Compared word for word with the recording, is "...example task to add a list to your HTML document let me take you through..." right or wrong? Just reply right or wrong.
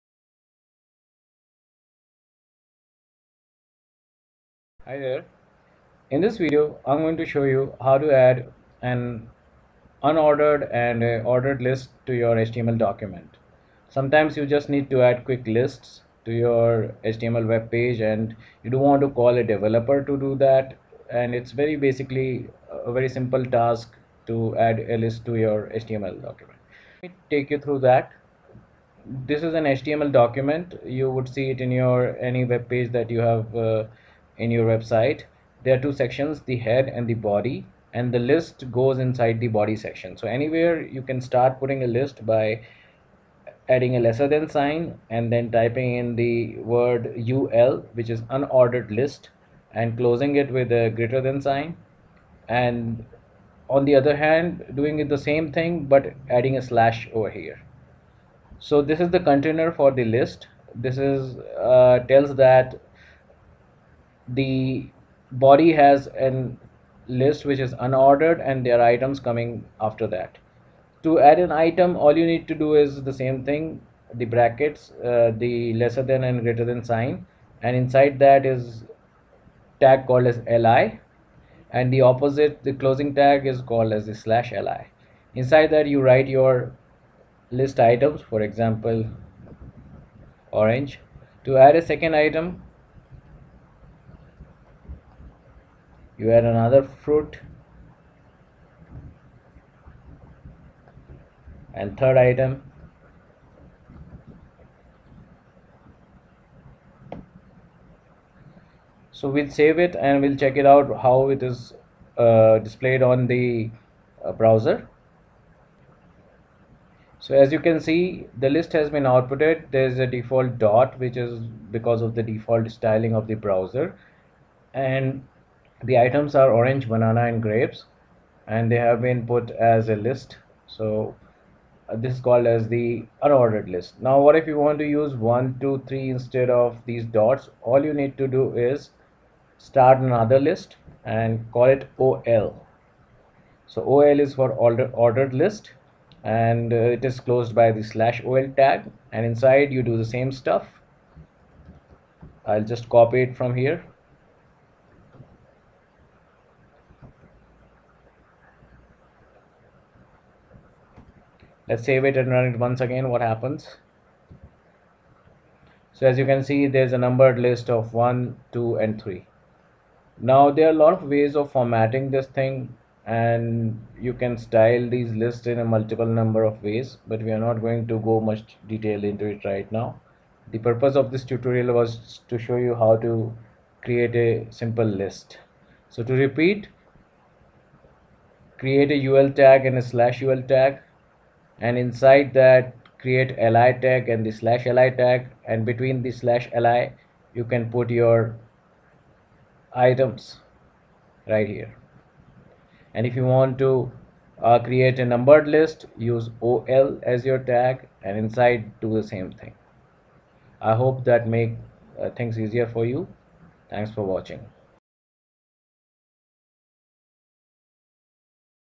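wrong.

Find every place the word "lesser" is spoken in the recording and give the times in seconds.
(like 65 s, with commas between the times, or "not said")
44 s, 75 s.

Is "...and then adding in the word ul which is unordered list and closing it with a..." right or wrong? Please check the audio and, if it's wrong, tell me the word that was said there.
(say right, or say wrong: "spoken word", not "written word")
wrong: "typing", not "adding".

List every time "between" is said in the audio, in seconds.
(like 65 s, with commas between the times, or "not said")
195 s.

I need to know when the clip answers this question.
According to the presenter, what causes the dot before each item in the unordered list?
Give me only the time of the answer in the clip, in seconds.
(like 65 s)
122 s.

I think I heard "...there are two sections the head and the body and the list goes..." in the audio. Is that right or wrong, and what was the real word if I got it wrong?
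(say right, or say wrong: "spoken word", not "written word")
right.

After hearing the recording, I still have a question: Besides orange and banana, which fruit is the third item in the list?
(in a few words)
grapes.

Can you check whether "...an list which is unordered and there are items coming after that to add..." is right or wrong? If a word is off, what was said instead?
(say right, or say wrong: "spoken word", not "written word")
right.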